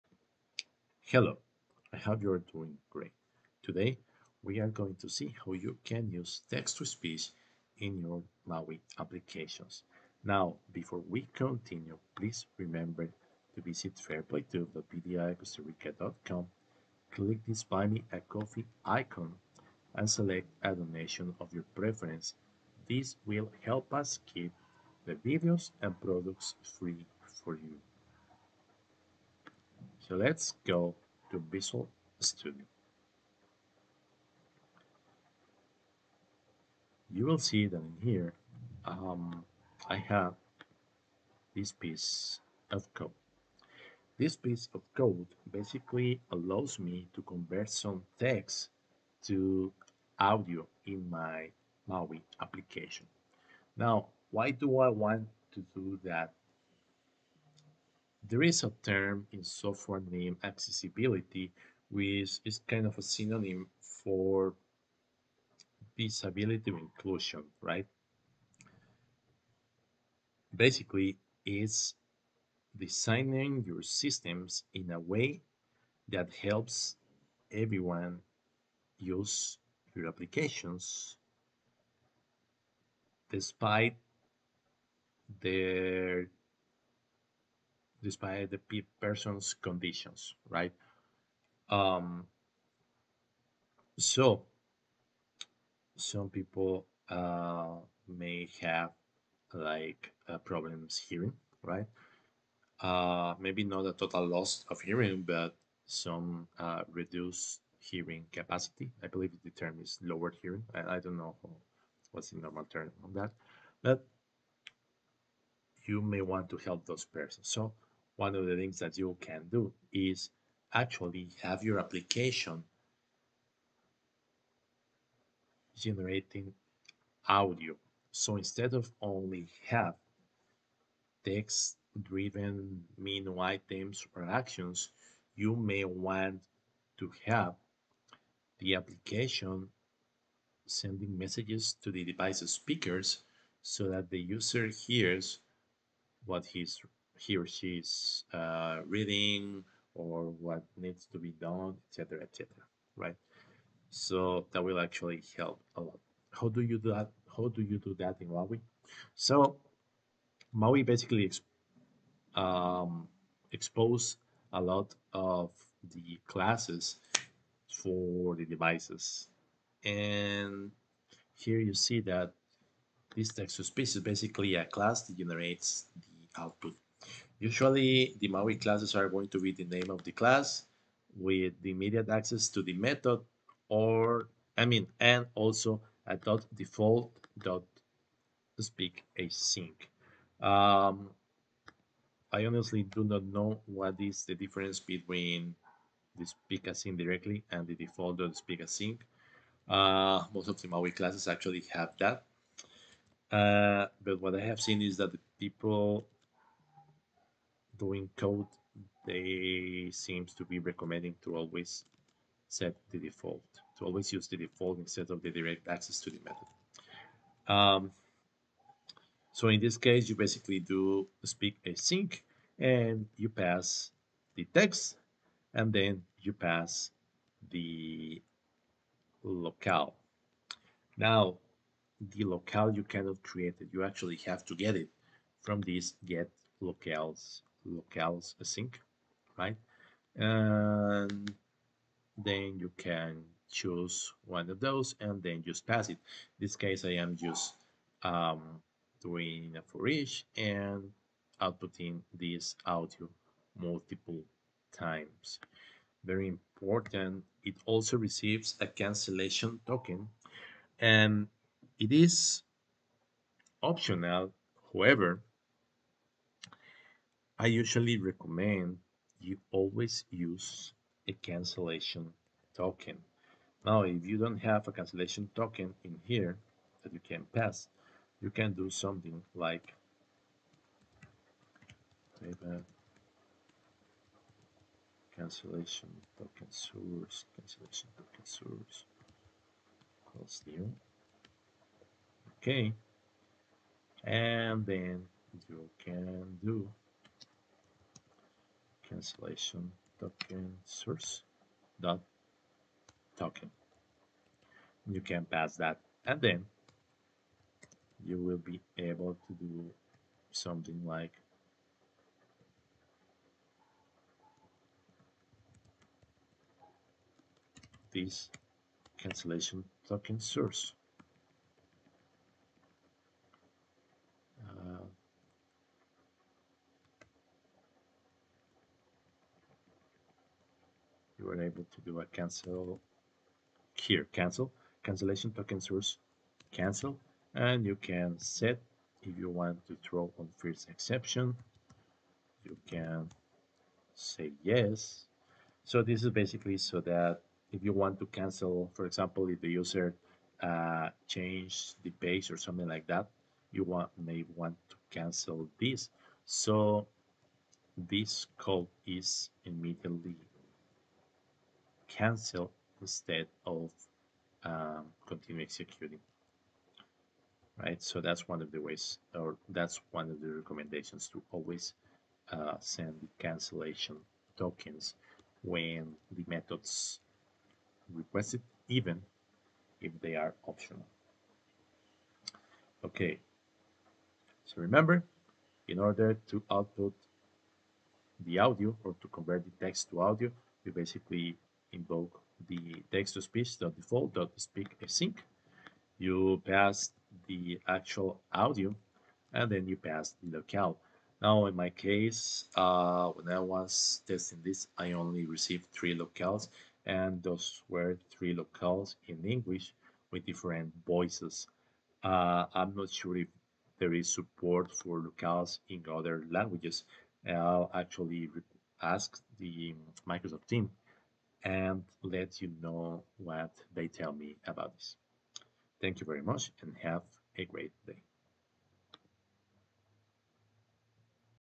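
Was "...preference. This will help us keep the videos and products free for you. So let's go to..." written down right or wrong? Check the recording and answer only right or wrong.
right.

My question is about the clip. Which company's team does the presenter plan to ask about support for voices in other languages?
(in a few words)
Microsoft.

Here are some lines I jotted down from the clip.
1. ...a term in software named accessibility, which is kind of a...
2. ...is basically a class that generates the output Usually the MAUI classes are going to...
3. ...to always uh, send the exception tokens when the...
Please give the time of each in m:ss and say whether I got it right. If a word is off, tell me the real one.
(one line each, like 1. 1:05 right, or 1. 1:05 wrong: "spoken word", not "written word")
1. 0:58 right
2. 2:53 right
3. 6:11 wrong: "cancellation", not "exception".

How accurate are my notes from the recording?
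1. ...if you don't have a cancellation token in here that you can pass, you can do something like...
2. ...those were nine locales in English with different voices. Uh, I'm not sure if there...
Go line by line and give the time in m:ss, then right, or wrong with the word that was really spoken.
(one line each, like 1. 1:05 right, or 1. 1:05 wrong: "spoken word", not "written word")
1. 4:33 right
2. 6:47 wrong: "three", not "nine".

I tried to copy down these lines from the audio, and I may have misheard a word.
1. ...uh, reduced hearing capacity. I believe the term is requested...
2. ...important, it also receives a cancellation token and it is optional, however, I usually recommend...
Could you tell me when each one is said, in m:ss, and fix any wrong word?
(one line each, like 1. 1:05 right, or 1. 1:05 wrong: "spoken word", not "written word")
1. 1:46 wrong: "lowered", not "requested"
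2. 4:16 right.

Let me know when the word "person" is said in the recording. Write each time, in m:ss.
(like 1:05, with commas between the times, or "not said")
1:28, 1:57.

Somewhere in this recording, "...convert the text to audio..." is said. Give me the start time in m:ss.
6:29.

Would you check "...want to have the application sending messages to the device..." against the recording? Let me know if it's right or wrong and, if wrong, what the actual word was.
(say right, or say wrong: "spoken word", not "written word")
right.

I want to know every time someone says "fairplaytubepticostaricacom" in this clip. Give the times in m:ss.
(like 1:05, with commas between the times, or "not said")
0:13.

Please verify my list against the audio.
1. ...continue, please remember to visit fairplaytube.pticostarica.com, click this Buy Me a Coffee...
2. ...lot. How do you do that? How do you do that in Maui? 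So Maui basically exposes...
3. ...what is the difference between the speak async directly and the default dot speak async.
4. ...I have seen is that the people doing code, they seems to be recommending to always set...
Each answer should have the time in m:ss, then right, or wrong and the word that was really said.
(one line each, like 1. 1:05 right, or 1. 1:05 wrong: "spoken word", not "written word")
1. 0:11 right
2. 2:35 right
3. 3:13 right
4. 3:24 right.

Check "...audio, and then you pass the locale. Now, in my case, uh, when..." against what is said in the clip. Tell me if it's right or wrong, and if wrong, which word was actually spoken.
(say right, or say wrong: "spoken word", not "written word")
right.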